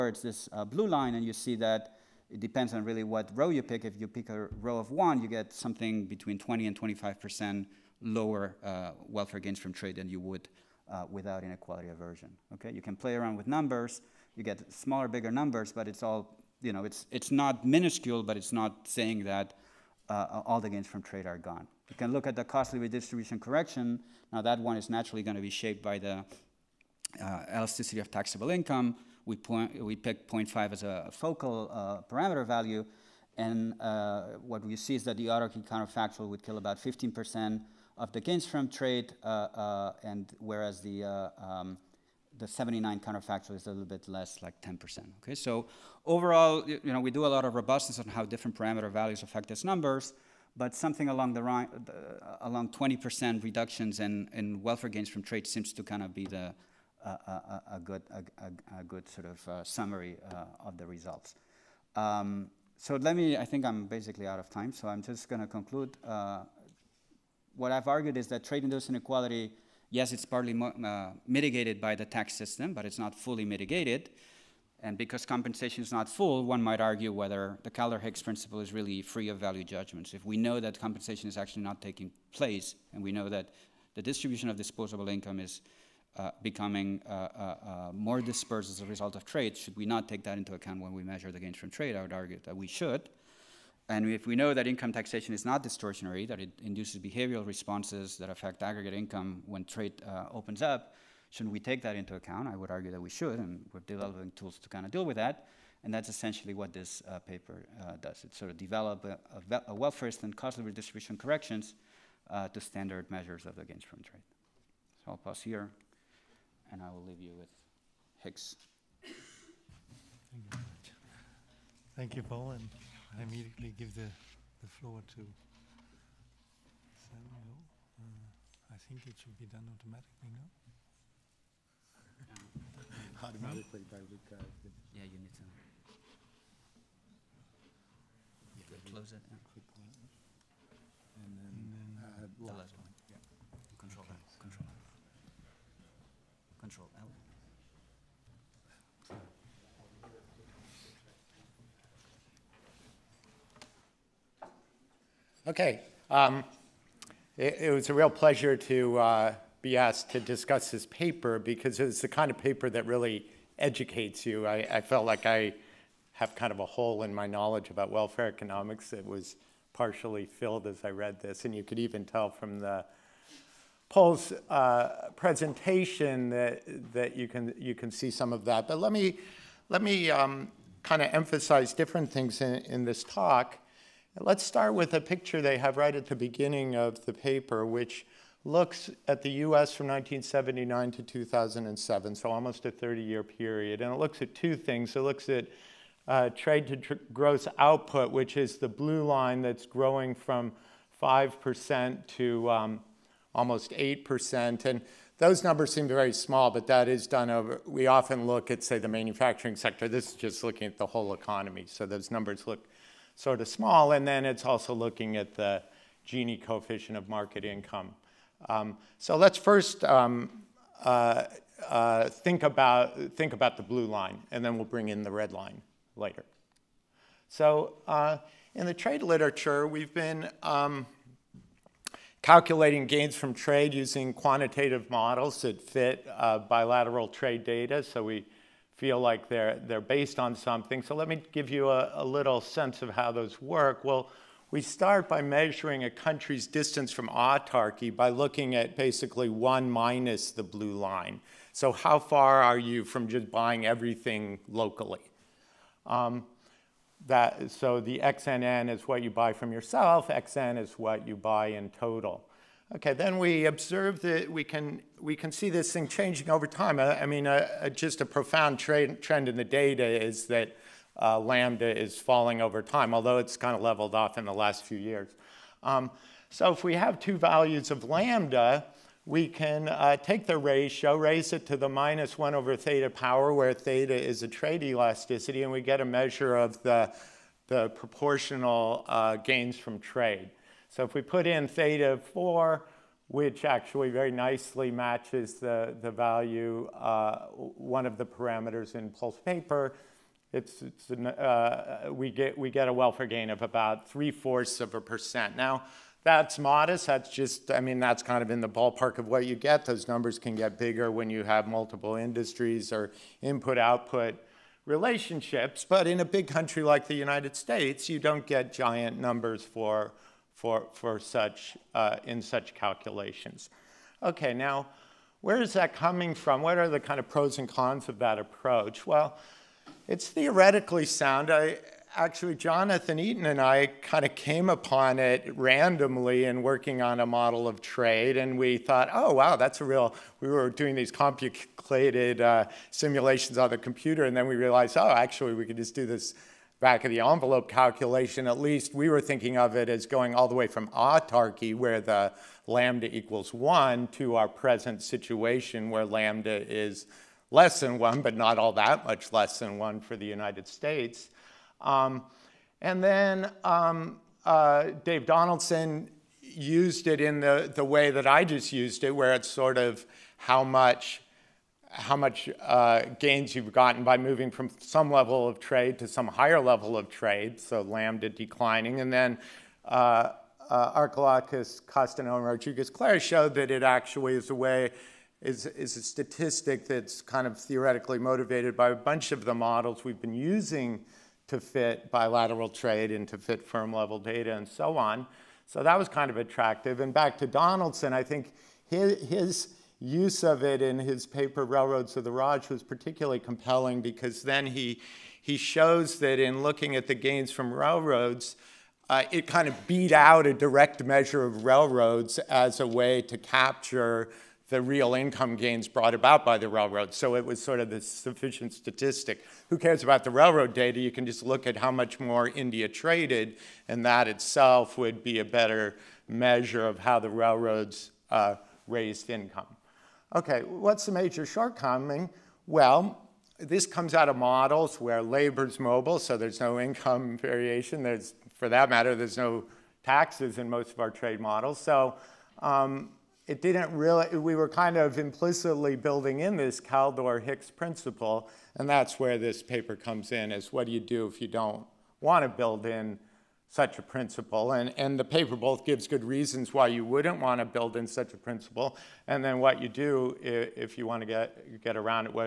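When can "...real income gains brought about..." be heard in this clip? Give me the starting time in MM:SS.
06:54.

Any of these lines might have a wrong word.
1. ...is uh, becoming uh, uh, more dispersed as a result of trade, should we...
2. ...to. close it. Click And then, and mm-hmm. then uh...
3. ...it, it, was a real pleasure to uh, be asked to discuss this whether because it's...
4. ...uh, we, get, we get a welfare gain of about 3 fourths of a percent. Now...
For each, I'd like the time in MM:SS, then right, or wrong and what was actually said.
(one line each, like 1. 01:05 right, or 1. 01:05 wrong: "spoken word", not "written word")
1. 01:25 right
2. 02:15 right
3. 02:37 wrong: "paper", not "whether"
4. 05:01 right.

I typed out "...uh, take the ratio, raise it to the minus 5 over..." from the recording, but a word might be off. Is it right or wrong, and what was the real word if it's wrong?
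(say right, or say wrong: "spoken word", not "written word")
wrong: "1", not "5".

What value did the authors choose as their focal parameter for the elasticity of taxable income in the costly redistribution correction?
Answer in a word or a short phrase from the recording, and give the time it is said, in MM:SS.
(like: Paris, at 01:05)
0.5, at 00:30.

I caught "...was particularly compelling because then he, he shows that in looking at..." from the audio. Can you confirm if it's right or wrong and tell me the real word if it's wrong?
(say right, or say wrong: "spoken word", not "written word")
right.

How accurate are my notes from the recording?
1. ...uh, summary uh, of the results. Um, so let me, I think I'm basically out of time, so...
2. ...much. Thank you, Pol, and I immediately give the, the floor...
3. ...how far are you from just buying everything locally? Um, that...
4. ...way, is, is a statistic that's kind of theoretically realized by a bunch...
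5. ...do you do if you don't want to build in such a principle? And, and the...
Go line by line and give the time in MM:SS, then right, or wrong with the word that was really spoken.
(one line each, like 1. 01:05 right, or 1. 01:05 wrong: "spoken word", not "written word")
1. 00:59 right
2. 02:01 right
3. 04:11 right
4. 06:24 wrong: "motivated", not "realized"
5. 07:30 right.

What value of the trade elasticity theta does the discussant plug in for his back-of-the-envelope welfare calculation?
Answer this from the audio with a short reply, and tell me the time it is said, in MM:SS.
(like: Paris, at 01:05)
4, at 04:51.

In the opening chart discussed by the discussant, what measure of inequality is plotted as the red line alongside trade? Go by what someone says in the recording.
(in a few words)
Gini coefficient of market income.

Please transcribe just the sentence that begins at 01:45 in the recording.
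And that's essentially what this uh, paper uh, does.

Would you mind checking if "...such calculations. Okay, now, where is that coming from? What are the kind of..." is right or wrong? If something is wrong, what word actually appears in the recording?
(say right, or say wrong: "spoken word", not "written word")
right.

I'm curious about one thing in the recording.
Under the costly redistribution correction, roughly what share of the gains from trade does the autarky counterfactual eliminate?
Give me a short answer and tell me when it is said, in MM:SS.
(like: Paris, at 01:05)
15%, at 00:36.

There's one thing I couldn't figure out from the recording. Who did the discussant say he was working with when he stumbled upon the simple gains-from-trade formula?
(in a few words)
Jonathan Eaton.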